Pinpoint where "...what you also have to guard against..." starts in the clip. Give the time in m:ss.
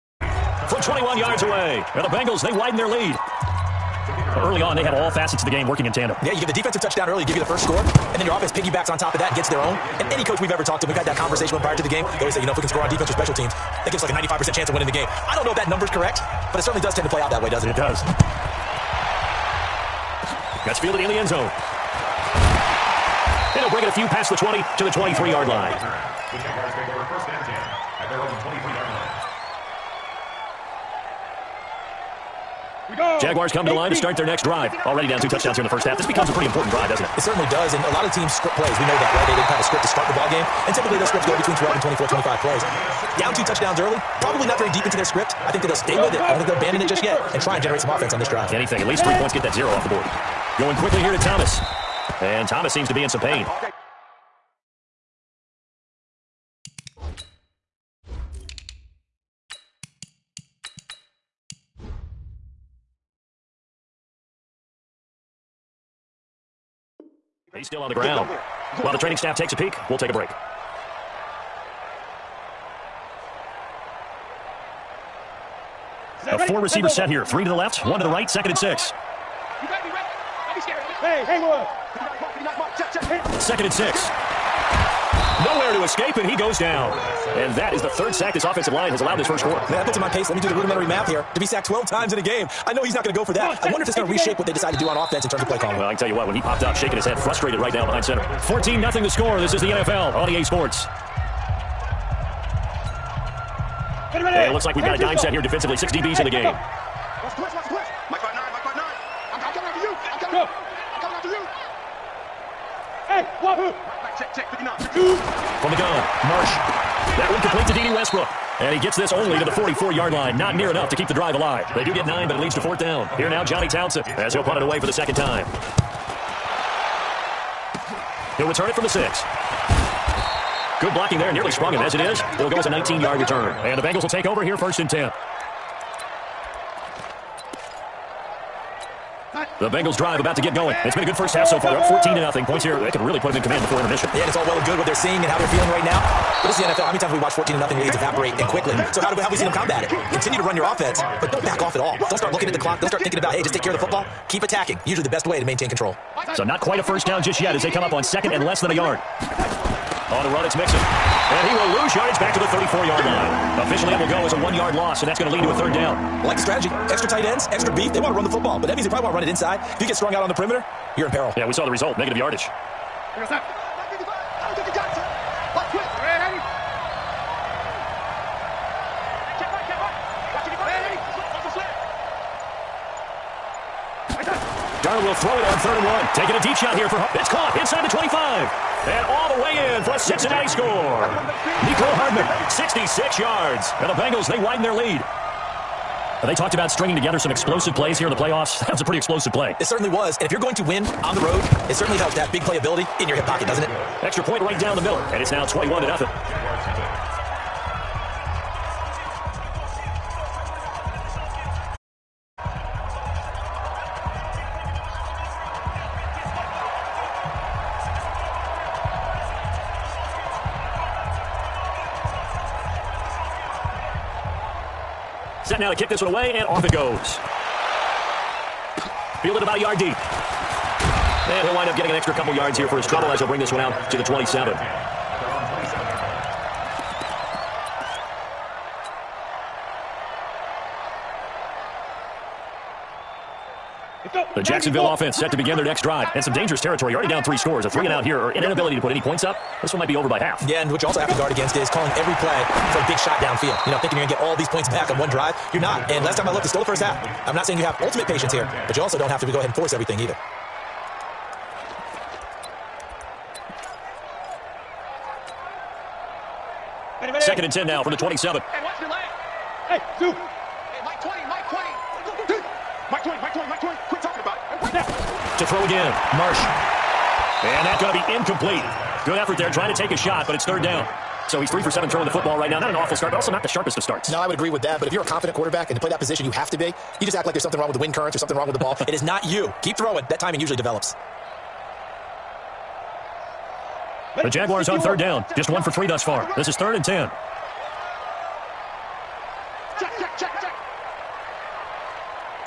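4:10.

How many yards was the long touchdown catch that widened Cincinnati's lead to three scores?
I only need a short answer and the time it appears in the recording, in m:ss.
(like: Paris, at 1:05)
66, at 3:12.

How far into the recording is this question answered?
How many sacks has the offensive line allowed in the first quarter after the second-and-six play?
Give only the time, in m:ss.
1:27.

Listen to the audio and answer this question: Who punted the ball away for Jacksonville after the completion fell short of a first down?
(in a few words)
Johnny Townsend.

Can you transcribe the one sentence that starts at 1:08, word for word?
While the training staff takes a peek, we'll take a break.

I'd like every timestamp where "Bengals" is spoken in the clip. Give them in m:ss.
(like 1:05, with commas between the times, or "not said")
0:02, 2:13, 2:19, 3:13.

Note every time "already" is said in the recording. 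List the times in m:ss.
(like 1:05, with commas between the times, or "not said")
0:34, 4:06.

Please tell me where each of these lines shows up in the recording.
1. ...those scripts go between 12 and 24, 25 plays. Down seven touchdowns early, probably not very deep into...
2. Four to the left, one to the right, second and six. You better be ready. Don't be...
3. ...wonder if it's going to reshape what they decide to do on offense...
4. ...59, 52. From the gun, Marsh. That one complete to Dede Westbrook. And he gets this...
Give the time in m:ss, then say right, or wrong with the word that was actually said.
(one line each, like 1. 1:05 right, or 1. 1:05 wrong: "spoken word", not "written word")
1. 0:41 wrong: "two", not "seven"
2. 1:17 wrong: "Three", not "Four"
3. 1:33 right
4. 1:54 right.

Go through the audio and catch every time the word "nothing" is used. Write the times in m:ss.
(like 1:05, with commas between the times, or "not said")
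1:38, 2:22, 2:27, 3:25.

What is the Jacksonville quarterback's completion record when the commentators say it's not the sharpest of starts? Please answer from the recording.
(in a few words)
3 for 7.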